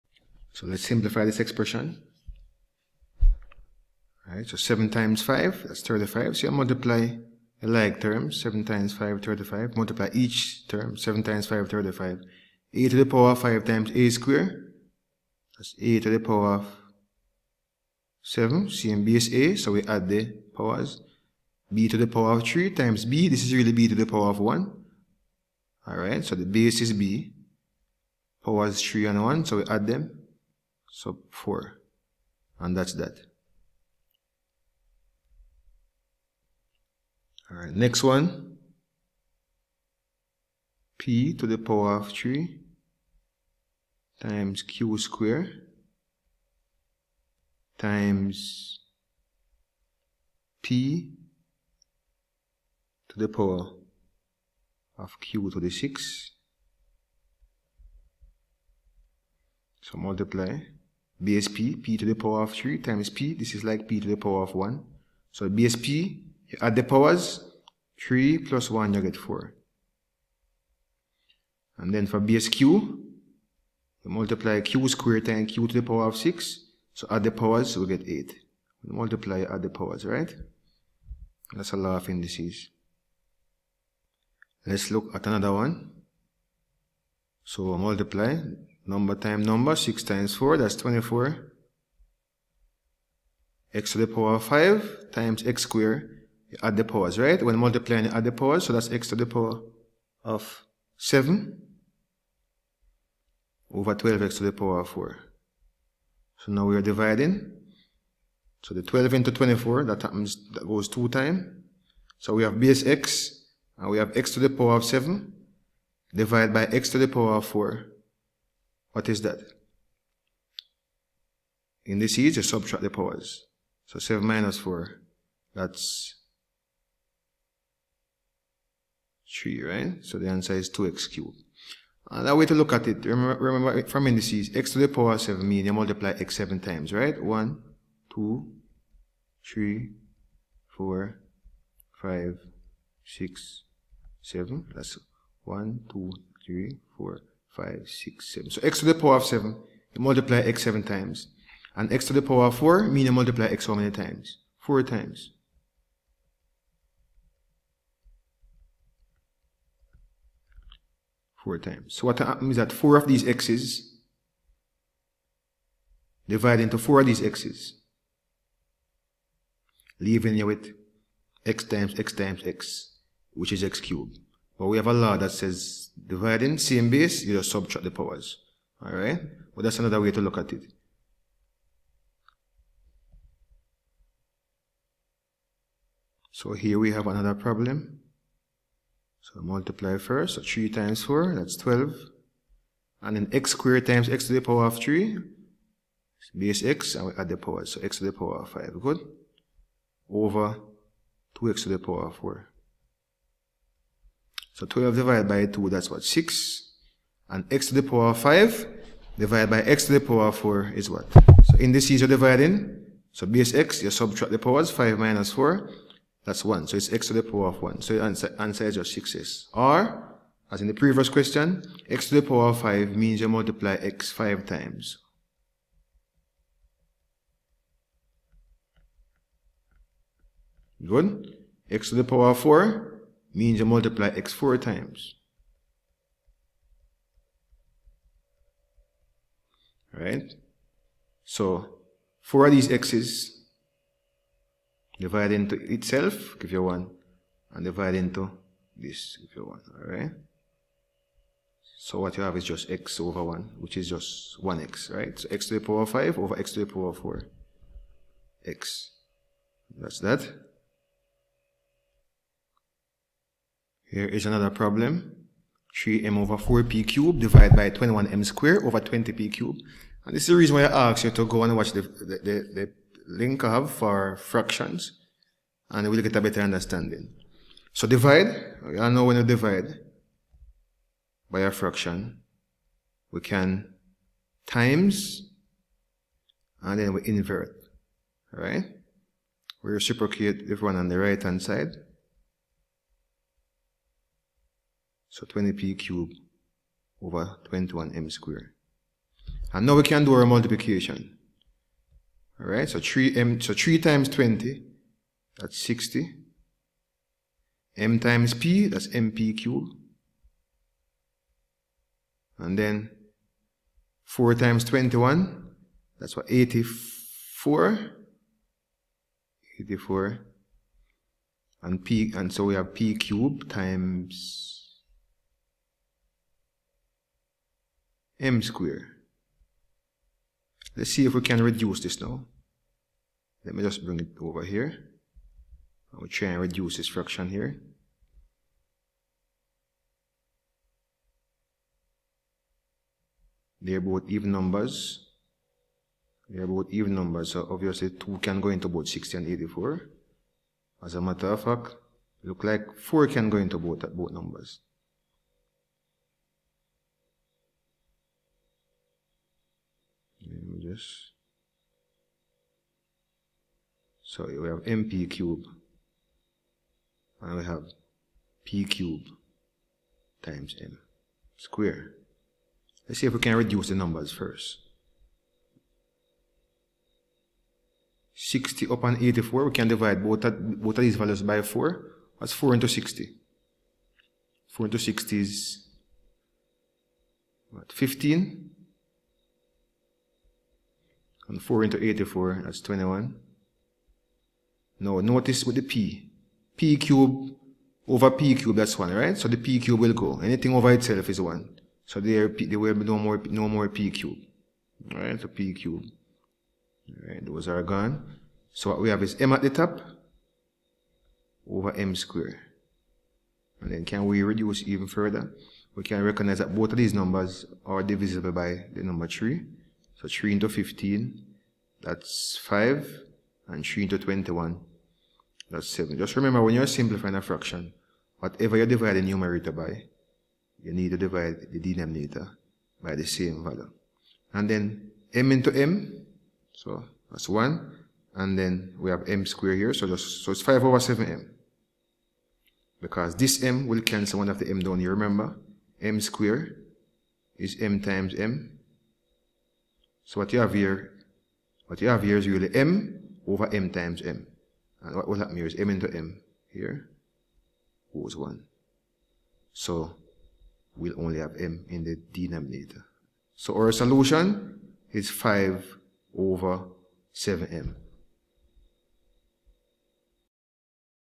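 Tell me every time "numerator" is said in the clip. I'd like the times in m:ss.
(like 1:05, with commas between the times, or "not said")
7:09.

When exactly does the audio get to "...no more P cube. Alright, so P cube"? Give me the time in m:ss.
6:43.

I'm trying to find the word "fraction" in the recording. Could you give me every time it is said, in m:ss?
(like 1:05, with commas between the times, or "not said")
4:34, 4:41, 5:36, 7:07.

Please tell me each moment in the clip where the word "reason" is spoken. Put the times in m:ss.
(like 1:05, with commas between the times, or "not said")
4:30.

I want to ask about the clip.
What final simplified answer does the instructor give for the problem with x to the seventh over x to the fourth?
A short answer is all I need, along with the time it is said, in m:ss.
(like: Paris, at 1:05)
2x cubed, at 2:10.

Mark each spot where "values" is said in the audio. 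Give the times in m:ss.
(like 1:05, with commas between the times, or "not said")
6:20, 7:13.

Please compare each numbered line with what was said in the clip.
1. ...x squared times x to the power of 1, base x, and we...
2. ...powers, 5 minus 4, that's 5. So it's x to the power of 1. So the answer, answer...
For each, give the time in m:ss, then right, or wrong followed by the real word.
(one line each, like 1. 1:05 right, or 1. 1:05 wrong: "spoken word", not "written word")
1. 3:13 wrong: "3", not "1"
2. 3:34 wrong: "1", not "5".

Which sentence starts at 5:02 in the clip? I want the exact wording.
Alright, so 3m, so 3 times 20, that's 60.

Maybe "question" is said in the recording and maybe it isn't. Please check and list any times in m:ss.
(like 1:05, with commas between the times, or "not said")
3:41.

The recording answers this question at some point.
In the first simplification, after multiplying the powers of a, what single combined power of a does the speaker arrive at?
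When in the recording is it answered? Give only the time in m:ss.
0:15.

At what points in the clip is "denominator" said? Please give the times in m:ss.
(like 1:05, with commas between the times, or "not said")
7:11, 7:42.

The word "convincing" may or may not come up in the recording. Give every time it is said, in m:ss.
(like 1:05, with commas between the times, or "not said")
not said.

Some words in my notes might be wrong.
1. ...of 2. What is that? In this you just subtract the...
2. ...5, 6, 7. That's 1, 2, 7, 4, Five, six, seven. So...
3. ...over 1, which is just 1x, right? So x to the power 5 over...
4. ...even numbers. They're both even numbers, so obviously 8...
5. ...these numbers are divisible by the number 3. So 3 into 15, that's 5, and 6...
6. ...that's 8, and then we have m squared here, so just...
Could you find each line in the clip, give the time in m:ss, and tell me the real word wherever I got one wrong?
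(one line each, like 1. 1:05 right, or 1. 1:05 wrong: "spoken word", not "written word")
1. 1:57 wrong: "4", not "2"
2. 2:22 wrong: "3", not "7"
3. 4:12 right
4. 5:44 wrong: "2", not "8"
5. 6:56 wrong: "3", not "6"
6. 7:17 wrong: "1", not "8".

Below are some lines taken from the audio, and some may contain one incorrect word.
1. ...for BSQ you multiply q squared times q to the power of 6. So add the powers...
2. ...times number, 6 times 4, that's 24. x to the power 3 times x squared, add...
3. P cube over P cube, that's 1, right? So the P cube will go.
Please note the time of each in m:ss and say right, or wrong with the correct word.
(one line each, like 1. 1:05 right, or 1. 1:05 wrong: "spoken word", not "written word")
1. 1:12 right
2. 1:29 wrong: "5", not "3"
3. 6:36 right.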